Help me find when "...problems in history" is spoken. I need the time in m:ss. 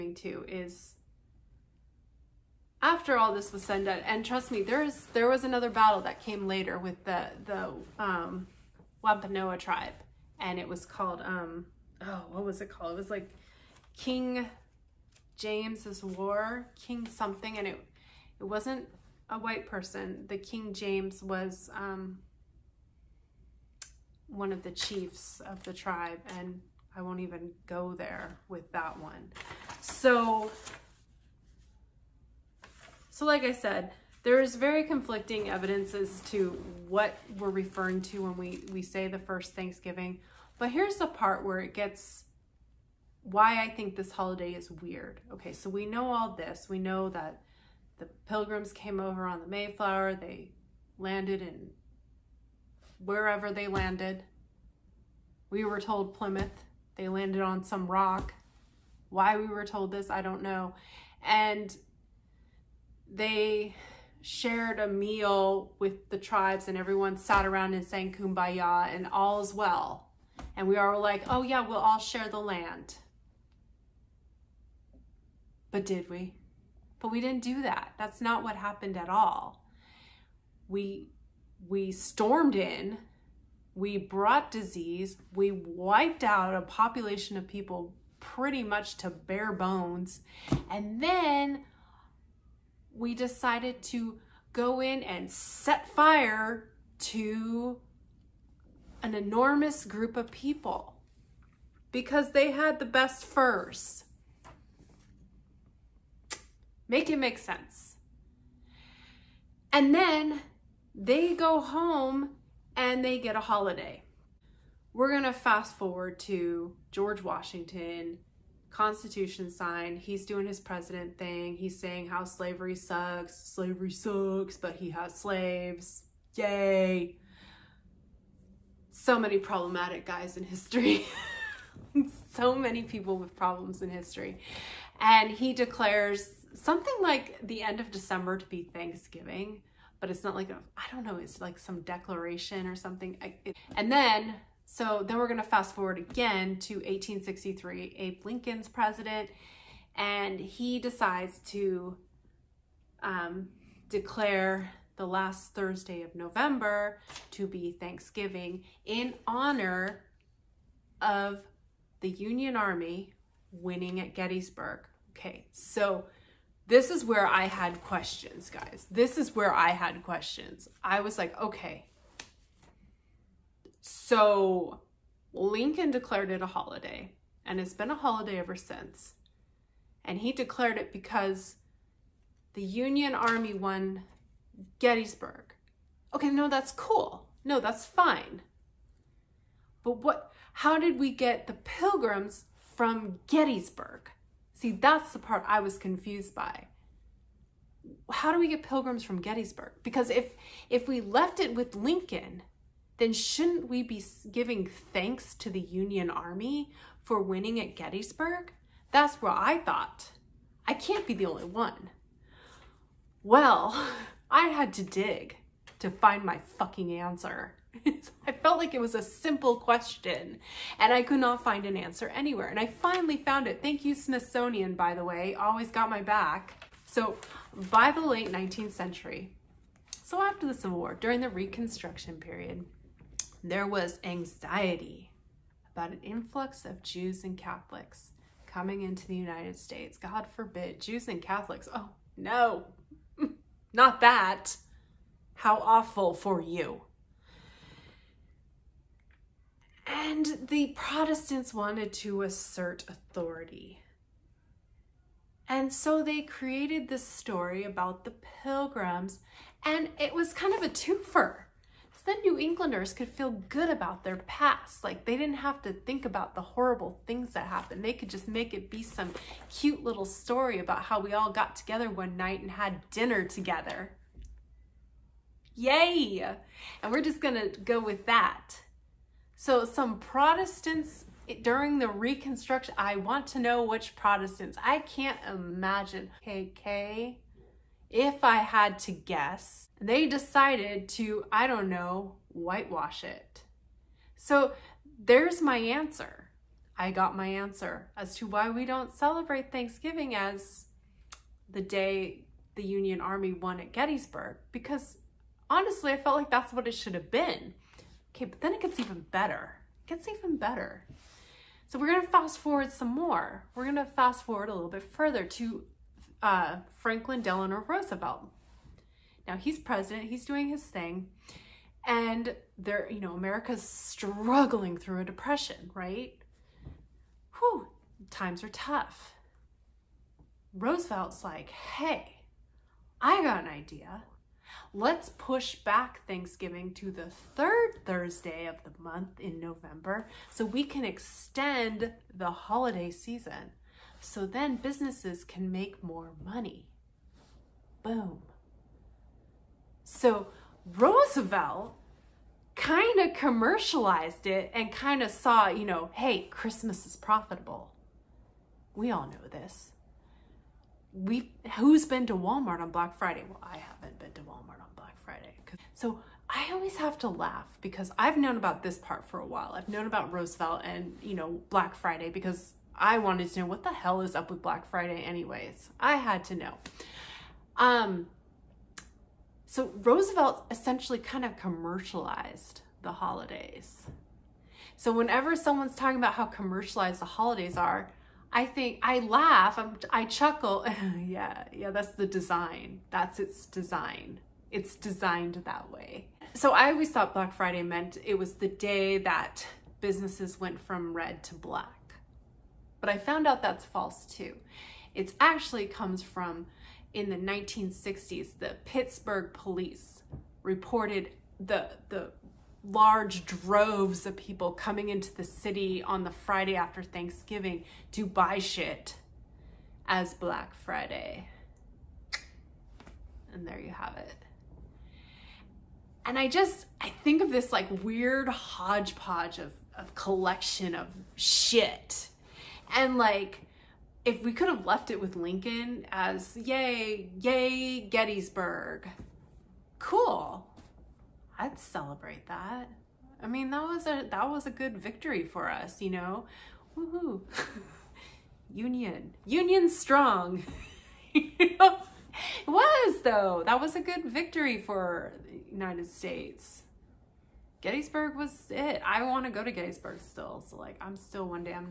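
2:13.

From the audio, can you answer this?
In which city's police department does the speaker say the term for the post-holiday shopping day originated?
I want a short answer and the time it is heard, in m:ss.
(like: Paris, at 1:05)
Pittsburgh, at 6:48.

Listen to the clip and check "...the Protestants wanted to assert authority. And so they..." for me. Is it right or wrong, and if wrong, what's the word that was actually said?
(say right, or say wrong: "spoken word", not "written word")
right.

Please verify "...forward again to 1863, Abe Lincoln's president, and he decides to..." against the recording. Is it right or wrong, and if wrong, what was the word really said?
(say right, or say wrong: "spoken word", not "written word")
right.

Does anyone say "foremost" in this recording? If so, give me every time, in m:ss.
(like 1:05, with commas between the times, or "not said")
not said.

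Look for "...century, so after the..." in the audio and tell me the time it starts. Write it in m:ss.
3:48.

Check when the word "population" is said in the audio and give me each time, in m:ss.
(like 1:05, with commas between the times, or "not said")
1:26.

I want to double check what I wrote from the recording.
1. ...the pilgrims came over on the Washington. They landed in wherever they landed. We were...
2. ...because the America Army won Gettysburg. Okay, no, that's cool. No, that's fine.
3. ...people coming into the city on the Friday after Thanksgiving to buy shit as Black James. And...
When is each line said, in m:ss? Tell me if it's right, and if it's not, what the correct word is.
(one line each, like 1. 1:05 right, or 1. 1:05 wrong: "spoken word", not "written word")
1. 0:47 wrong: "Mayflower", not "Washington"
2. 3:00 wrong: "Union", not "America"
3. 6:54 wrong: "Friday", not "James".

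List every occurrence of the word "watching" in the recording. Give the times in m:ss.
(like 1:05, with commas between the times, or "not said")
not said.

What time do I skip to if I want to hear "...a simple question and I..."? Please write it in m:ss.
3:38.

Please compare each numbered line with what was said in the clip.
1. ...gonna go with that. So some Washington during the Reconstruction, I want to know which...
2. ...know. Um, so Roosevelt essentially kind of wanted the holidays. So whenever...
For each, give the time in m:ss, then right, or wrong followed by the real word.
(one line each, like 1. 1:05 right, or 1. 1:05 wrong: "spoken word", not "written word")
1. 4:37 wrong: "Protestants", not "Washington"
2. 6:16 wrong: "commercialized", not "wanted".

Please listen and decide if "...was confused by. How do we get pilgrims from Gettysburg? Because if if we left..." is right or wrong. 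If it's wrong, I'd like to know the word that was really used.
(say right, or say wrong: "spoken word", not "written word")
right.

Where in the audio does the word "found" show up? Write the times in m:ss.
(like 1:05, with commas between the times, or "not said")
3:43, 6:42.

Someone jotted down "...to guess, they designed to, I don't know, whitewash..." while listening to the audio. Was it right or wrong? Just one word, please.
wrong.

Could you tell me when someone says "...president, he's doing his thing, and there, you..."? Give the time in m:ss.
5:19.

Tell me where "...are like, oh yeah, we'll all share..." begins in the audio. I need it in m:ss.
1:10.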